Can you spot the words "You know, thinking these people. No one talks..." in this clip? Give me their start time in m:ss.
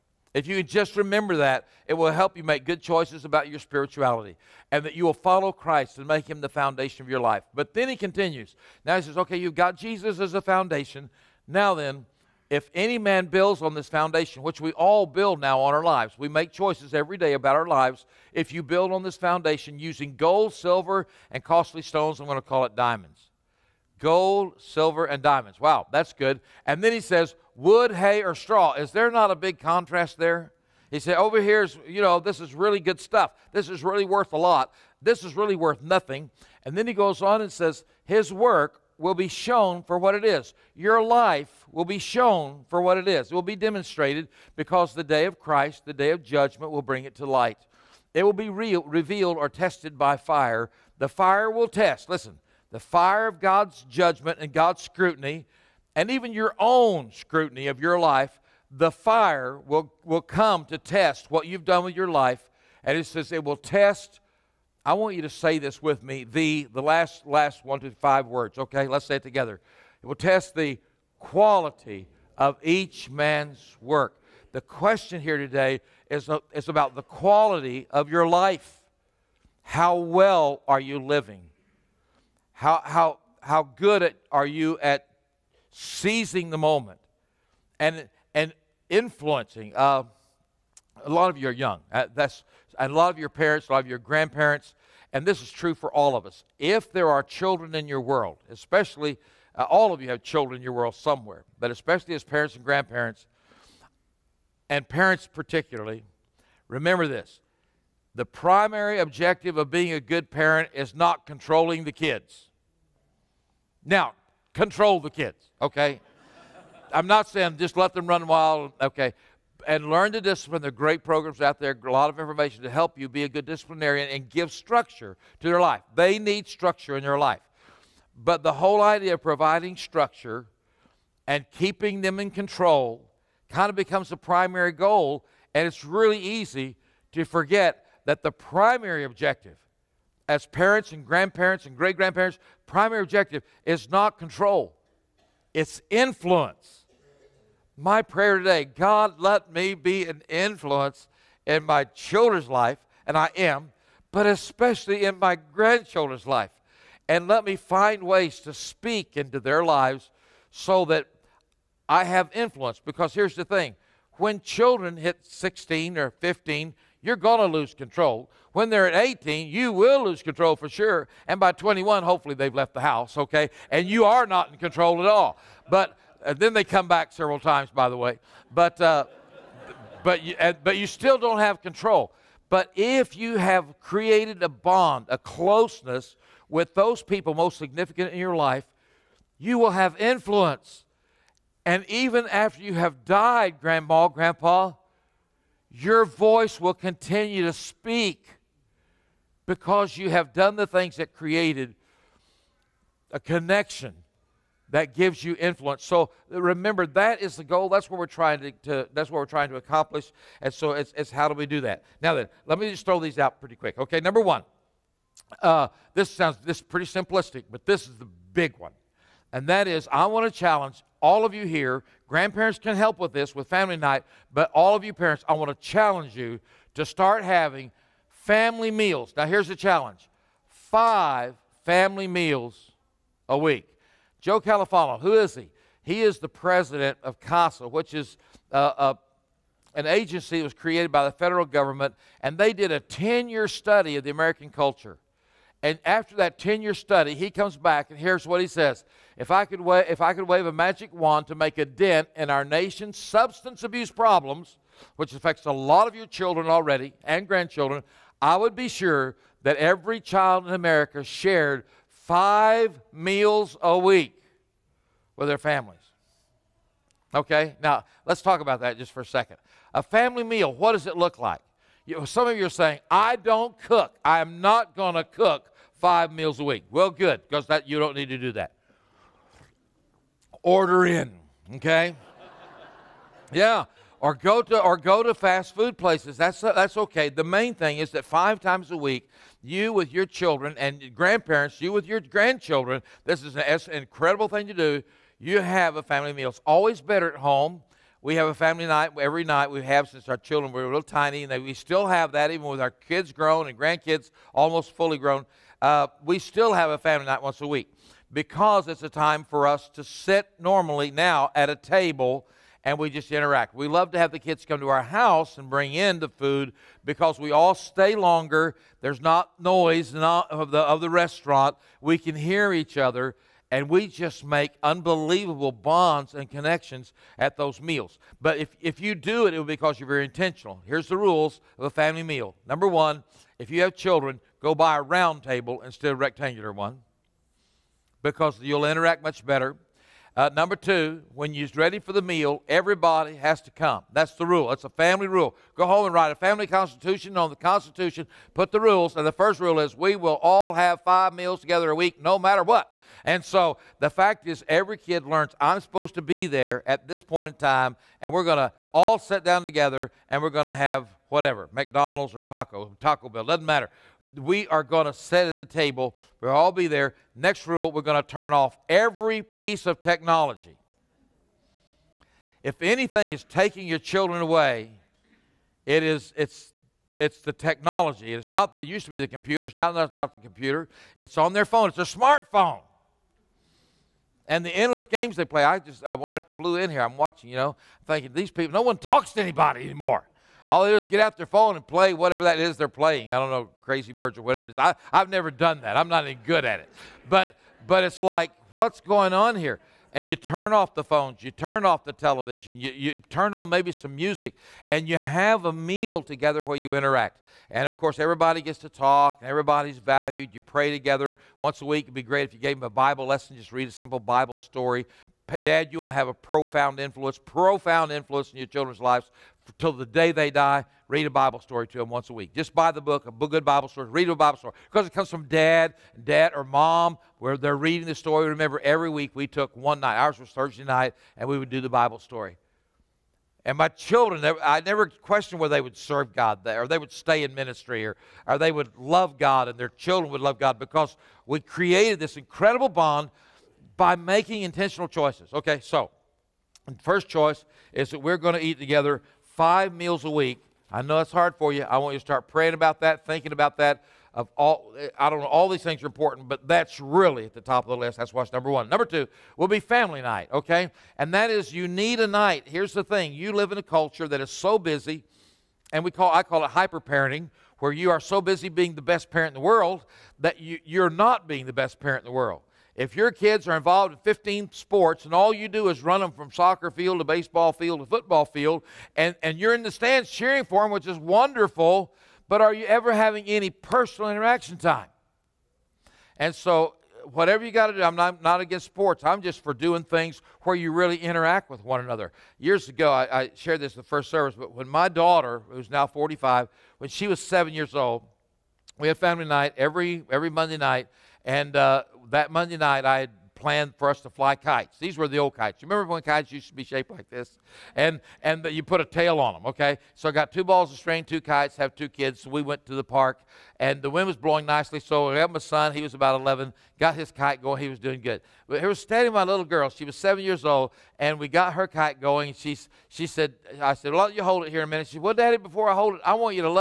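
6:27.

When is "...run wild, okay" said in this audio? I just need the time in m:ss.
1:58.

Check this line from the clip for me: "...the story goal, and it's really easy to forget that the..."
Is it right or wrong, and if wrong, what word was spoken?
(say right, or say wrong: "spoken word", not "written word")
wrong: "primary", not "story".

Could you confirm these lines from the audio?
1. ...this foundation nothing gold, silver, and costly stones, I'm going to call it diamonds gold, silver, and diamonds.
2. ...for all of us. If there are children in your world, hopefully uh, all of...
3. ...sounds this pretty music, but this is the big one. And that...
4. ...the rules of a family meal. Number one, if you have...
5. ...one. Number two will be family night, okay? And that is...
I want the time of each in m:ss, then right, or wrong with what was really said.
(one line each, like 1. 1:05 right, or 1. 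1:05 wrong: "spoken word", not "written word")
1. 0:19 wrong: "using", not "nothing"
2. 1:35 wrong: "especially", not "hopefully"
3. 3:36 wrong: "simplistic", not "music"
4. 5:30 right
5. 7:38 right.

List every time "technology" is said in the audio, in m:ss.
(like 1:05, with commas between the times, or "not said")
6:09, 6:17.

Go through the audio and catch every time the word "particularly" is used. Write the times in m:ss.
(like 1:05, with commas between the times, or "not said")
1:45.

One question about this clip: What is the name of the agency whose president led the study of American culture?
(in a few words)
CASA.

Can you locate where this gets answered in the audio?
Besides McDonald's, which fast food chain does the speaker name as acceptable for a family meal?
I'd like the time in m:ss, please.
6:02.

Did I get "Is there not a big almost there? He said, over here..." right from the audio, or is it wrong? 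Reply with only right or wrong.
wrong.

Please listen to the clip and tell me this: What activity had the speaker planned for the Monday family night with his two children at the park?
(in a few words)
Fly kites.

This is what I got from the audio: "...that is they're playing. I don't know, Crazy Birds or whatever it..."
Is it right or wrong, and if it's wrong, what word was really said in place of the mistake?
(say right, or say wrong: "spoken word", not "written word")
right.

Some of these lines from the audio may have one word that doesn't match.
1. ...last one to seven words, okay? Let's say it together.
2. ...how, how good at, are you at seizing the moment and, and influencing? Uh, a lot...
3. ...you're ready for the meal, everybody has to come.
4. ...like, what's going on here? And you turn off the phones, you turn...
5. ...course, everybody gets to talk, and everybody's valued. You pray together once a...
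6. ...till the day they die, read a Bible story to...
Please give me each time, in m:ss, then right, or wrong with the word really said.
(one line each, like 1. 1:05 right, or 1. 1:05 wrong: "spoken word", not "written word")
1. 1:07 wrong: "five", not "seven"
2. 1:22 right
3. 5:41 right
4. 6:38 right
5. 6:47 right
6. 6:59 right.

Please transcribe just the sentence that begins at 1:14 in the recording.
The question here today is, is about the quality of your life.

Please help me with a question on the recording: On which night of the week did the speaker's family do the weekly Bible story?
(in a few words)
Thursday.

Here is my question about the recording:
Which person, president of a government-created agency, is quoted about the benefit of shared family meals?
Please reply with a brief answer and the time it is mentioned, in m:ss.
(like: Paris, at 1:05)
Joe Califano, at 3:54.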